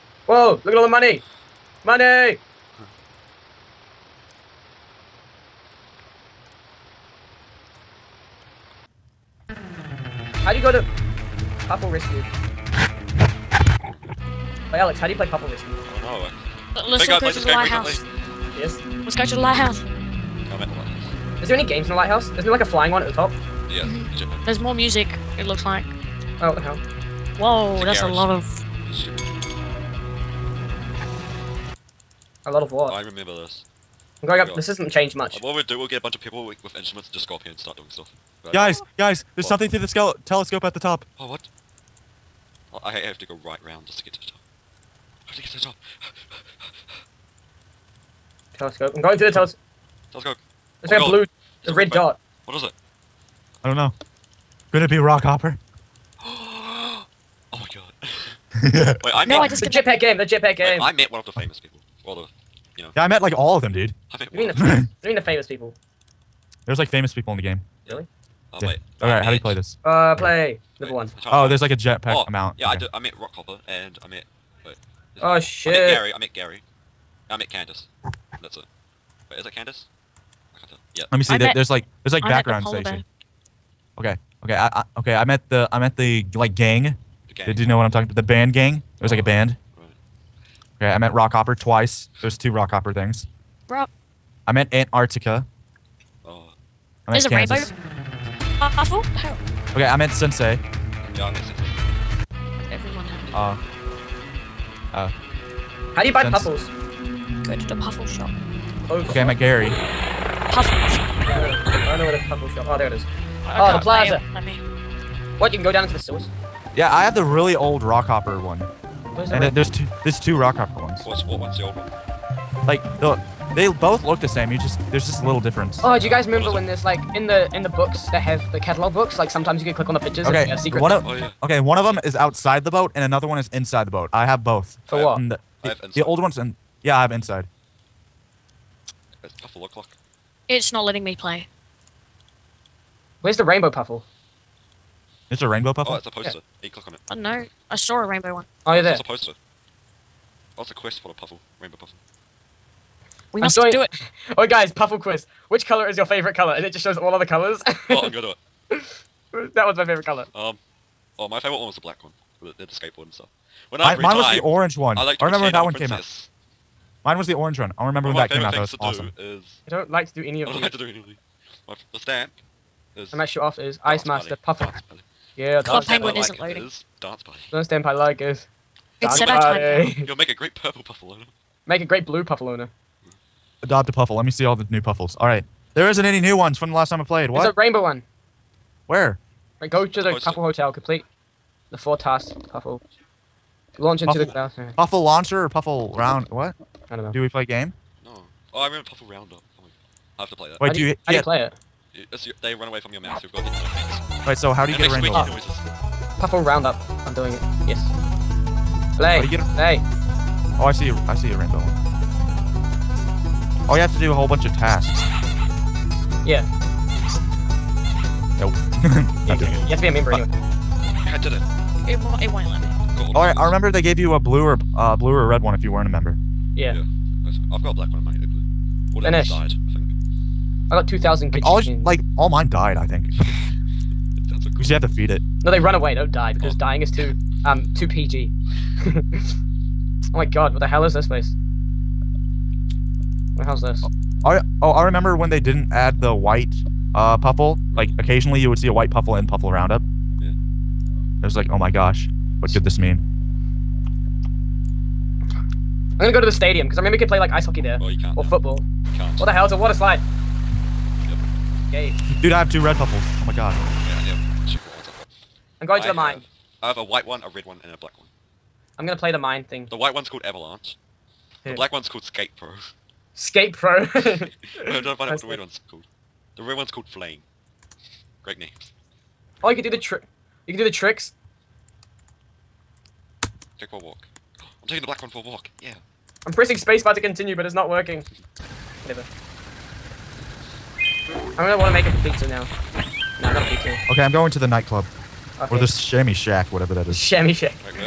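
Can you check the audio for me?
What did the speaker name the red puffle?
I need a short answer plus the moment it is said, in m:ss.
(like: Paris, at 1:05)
Flame, at 4:36.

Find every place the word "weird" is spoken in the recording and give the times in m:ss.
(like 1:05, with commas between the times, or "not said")
not said.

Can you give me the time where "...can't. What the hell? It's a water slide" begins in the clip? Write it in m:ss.
4:18.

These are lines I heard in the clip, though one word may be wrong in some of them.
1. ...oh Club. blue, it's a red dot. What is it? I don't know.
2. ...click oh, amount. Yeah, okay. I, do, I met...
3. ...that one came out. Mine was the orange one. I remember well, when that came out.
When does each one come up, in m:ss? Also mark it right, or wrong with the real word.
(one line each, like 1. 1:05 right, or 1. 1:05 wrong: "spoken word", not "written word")
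1. 0:51 wrong: "God", not "Club"
2. 1:11 wrong: "jetpack", not "click"
3. 2:45 right.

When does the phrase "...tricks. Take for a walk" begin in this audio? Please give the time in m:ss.
4:40.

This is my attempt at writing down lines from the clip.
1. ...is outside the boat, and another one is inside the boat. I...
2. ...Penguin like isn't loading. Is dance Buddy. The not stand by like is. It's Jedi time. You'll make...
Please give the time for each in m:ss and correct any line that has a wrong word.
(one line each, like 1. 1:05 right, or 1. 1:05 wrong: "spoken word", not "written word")
1. 2:12 right
2. 2:55 right.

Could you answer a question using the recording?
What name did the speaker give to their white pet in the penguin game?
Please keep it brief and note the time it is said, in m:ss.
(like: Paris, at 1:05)
Avalanche, at 4:30.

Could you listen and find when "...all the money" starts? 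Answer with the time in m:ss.
0:00.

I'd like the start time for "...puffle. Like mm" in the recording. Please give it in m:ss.
4:07.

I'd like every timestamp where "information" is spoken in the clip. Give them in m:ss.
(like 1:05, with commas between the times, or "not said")
not said.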